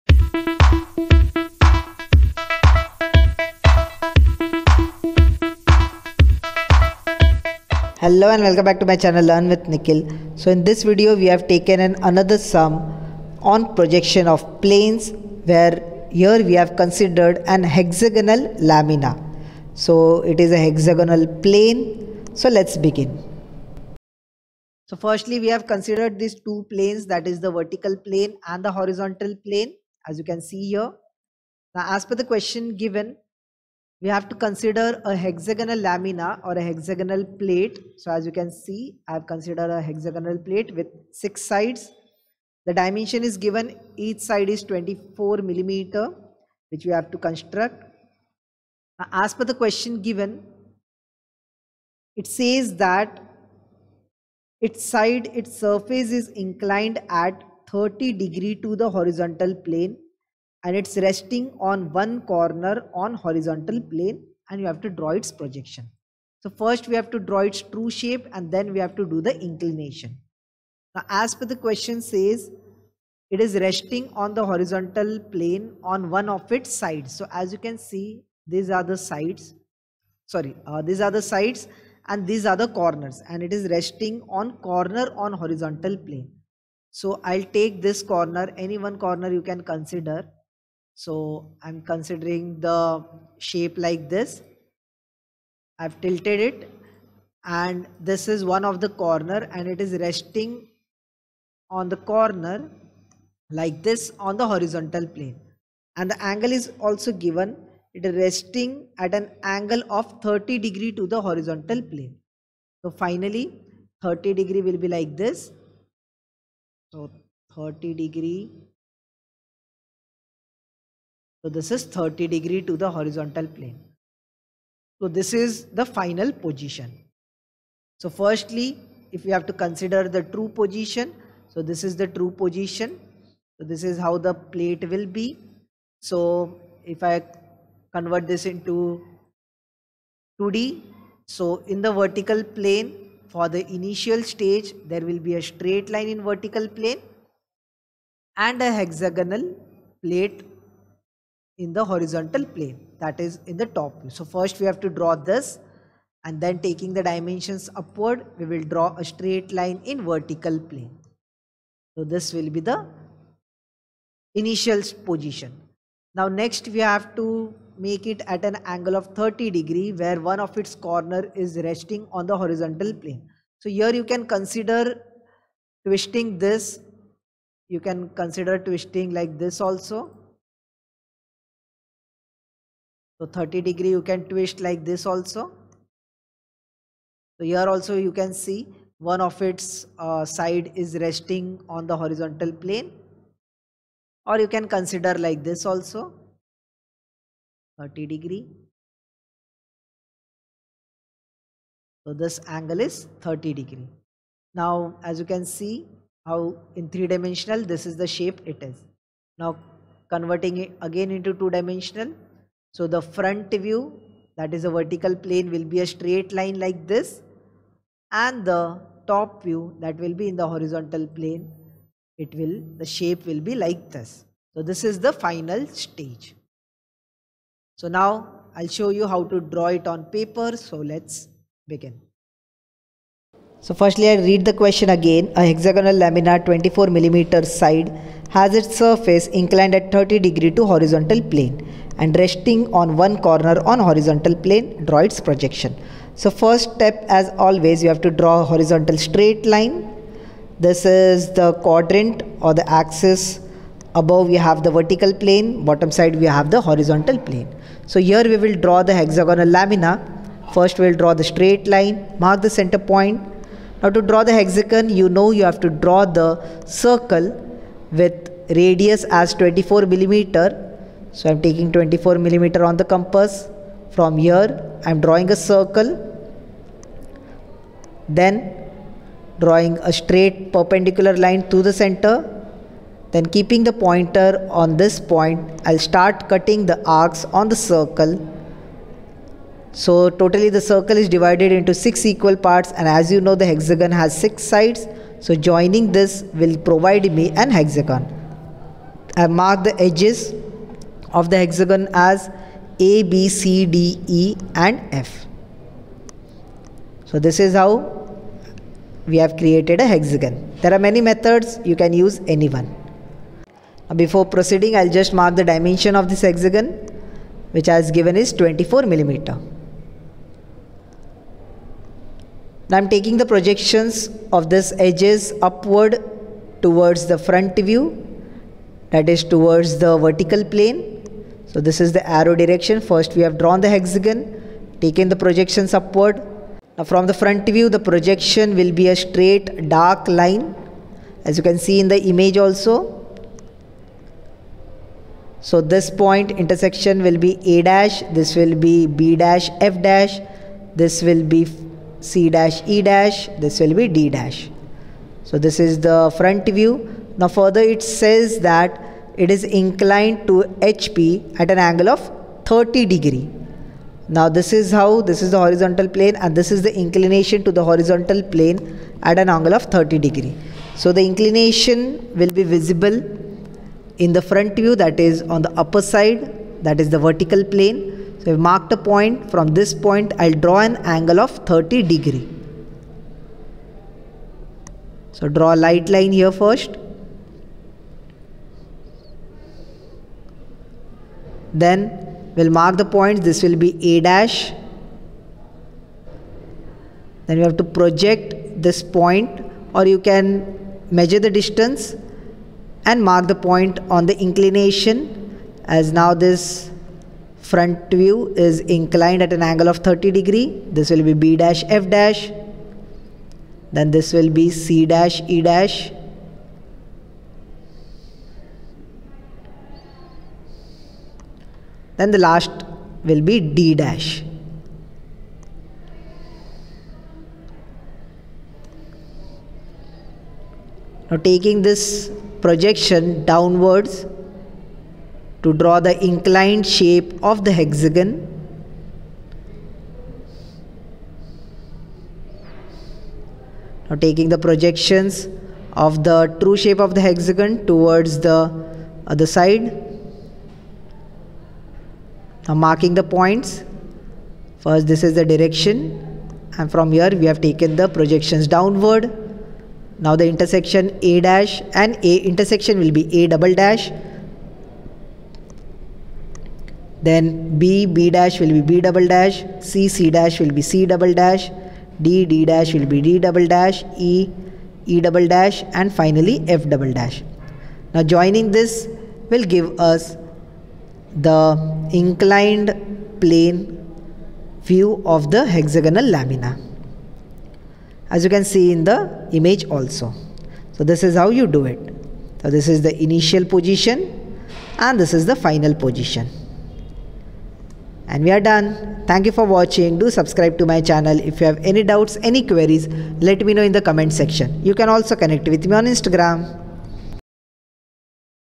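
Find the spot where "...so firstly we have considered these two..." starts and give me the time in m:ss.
0:24.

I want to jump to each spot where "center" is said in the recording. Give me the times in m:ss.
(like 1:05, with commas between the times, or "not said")
4:22, 4:41.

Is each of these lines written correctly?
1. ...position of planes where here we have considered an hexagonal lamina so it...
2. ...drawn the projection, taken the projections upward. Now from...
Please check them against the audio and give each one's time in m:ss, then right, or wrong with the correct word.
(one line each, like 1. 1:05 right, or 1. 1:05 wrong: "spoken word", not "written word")
1. 0:13 wrong: "projection", not "position"
2. 5:33 wrong: "hexagon", not "projection".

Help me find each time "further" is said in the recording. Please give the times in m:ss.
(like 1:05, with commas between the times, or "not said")
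5:57.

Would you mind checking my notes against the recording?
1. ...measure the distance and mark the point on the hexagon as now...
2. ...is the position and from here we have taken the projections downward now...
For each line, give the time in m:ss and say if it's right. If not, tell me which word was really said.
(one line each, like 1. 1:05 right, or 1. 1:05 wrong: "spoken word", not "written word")
1. 6:40 wrong: "inclination", not "hexagon"
2. 7:35 wrong: "direction", not "position".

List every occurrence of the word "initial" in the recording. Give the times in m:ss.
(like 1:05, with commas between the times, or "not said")
2:23, 2:44, 8:13.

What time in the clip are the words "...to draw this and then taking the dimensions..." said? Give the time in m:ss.
2:34.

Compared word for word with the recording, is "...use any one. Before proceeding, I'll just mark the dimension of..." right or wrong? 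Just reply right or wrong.
right.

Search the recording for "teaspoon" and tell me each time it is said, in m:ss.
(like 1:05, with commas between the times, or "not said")
not said.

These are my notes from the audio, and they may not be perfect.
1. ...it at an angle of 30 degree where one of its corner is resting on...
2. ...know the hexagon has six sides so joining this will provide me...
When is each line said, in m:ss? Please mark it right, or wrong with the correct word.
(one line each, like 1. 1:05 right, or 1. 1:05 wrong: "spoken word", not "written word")
1. 2:48 right
2. 4:53 right.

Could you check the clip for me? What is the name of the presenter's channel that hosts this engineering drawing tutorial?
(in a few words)
Learn with Nikhil.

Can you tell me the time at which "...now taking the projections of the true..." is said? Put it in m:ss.
7:23.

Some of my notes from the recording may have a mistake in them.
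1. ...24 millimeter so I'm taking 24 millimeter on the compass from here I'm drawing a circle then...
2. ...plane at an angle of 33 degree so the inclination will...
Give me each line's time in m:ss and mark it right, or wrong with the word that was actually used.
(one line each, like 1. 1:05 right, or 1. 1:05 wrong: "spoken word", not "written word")
1. 4:29 right
2. 6:08 wrong: "30", not "33".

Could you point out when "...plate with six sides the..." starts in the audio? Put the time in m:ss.
0:40.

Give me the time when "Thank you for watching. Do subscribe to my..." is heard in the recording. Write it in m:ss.
8:19.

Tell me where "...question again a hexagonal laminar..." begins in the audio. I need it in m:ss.
3:54.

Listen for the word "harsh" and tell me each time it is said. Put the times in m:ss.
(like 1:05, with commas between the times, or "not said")
not said.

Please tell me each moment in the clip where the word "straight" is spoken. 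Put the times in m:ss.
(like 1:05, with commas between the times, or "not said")
2:25, 2:39, 3:35, 4:08, 4:21, 4:39, 5:38.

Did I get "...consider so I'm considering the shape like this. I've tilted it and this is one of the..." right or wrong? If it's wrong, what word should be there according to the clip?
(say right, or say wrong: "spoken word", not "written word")
right.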